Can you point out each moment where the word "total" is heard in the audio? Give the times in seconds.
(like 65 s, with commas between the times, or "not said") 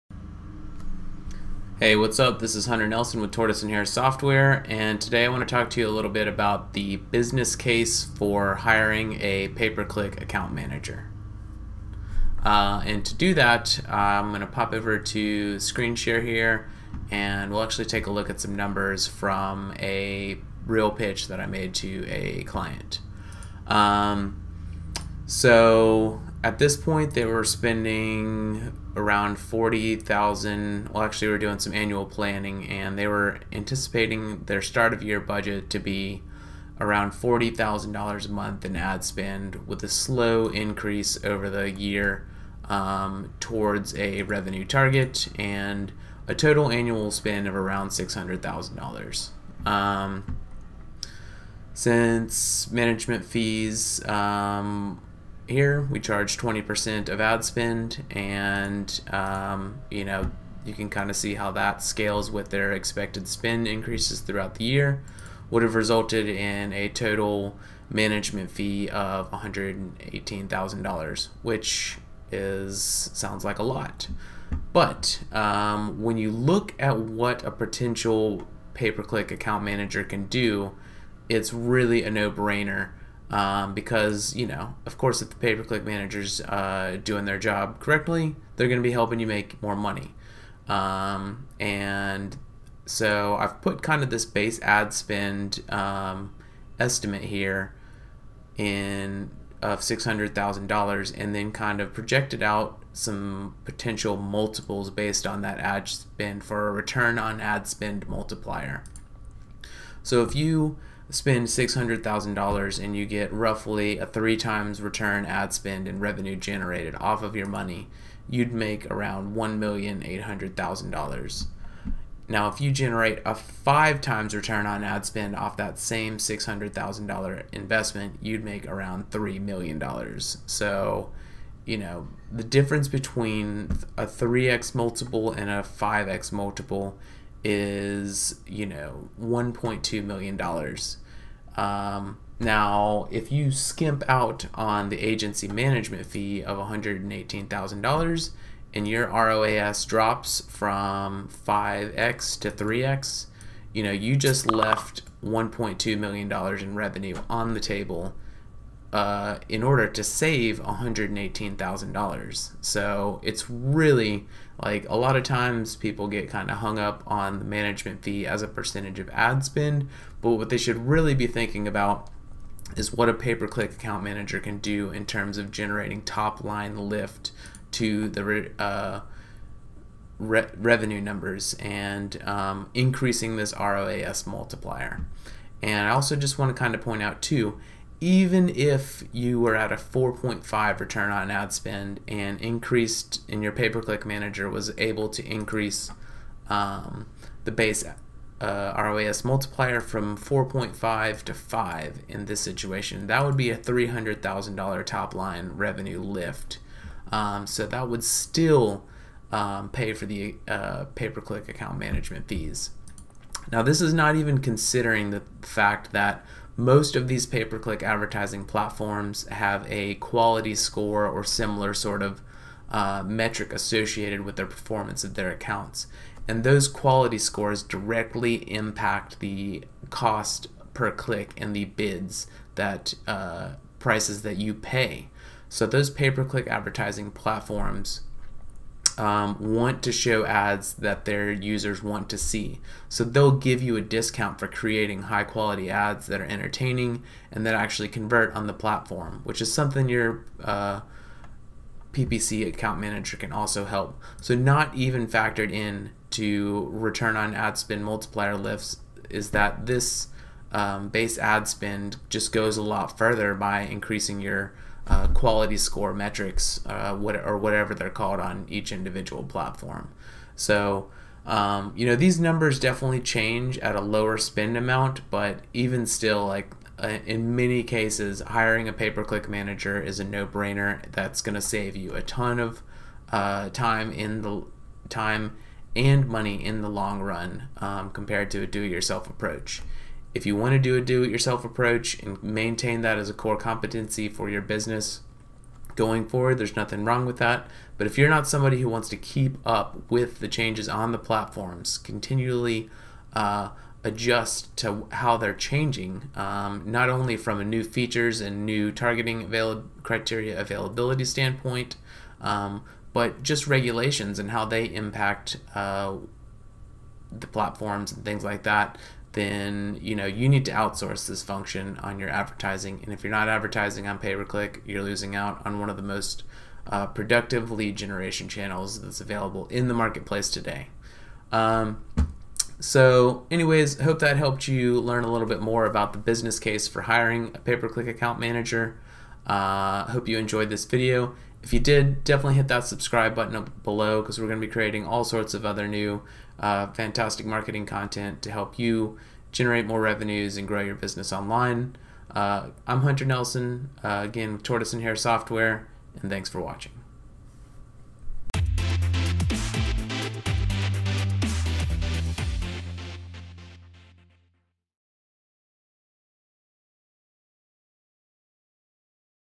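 46 s, 66 s.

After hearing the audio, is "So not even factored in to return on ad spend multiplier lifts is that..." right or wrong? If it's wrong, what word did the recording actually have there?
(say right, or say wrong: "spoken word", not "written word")
right.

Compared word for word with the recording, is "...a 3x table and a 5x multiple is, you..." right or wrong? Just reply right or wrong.
wrong.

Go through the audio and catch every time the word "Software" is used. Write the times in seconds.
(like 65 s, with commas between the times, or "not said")
3 s, 354 s.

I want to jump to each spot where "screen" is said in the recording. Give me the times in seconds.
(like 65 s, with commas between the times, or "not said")
15 s.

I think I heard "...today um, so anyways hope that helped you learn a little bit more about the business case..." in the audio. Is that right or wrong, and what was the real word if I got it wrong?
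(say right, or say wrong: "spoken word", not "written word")
right.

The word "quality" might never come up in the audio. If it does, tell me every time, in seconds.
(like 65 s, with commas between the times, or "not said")
219 s, 226 s, 245 s, 265 s.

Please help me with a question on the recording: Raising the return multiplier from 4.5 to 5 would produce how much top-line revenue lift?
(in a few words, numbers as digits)
$300,000.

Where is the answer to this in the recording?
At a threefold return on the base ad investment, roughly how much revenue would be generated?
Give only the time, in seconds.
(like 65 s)
119 s.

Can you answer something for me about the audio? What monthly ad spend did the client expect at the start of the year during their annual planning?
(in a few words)
$40,000.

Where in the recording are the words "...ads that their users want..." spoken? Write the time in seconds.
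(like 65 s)
240 s.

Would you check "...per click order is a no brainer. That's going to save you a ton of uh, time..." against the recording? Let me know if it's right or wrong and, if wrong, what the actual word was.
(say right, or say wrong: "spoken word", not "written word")
wrong: "manager", not "order".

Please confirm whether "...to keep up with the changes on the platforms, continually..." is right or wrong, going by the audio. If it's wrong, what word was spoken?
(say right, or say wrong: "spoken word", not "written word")
right.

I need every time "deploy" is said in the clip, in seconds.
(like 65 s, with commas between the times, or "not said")
not said.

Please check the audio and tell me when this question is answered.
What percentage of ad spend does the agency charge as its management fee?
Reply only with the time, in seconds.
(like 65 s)
56 s.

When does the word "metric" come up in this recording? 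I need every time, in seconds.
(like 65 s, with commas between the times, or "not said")
223 s, 265 s.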